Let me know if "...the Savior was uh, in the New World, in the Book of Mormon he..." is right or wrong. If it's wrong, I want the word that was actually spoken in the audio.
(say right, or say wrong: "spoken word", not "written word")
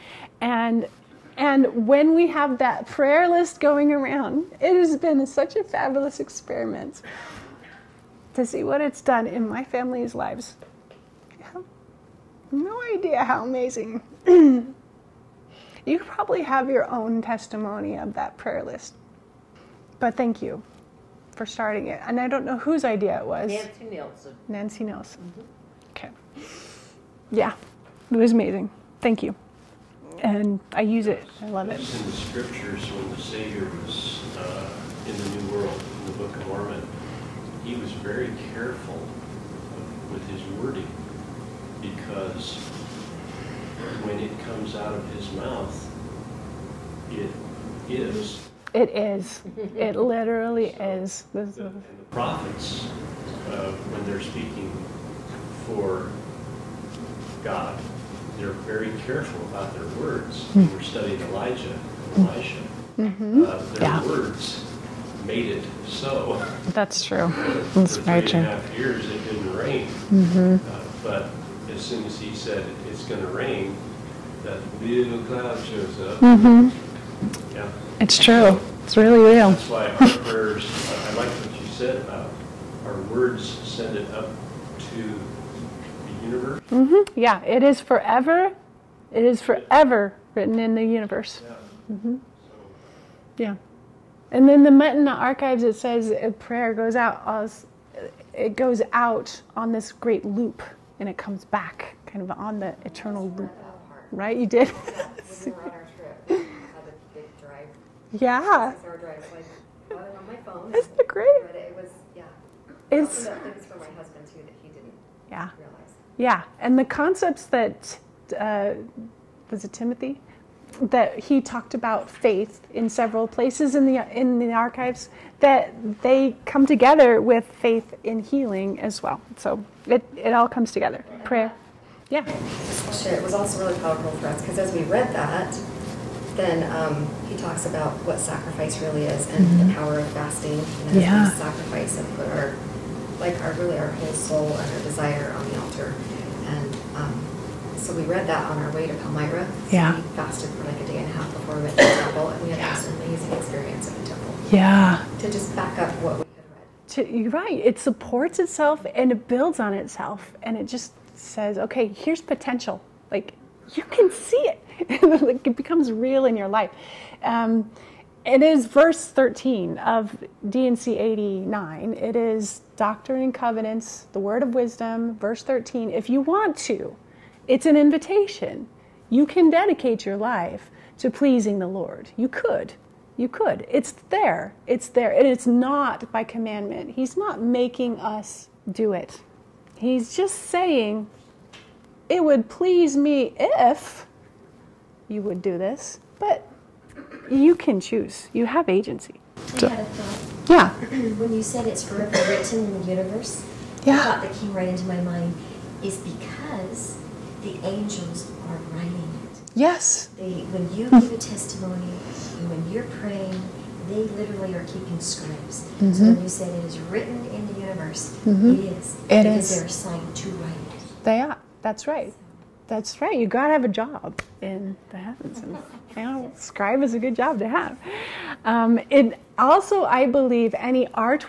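right.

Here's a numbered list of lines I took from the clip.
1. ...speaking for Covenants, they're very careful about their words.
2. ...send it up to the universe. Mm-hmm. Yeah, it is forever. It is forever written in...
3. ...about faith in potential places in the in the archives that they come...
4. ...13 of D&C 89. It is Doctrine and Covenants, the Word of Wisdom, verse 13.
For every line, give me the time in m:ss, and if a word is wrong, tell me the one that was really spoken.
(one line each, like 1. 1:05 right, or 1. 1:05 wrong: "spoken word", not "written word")
1. 0:54 wrong: "God", not "Covenants"
2. 1:23 right
3. 2:01 wrong: "several", not "potential"
4. 2:49 right.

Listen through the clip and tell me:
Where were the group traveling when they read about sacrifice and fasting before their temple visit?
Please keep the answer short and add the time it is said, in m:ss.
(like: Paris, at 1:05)
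Palmyra, at 2:28.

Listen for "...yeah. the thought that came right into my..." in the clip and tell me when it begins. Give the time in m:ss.
3:23.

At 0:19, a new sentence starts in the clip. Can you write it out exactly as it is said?
But thank you for starting it.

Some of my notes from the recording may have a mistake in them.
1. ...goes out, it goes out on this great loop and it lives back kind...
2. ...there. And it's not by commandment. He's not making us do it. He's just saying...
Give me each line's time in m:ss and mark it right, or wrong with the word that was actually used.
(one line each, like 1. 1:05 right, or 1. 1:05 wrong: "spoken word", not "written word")
1. 1:36 wrong: "comes", not "lives"
2. 3:04 right.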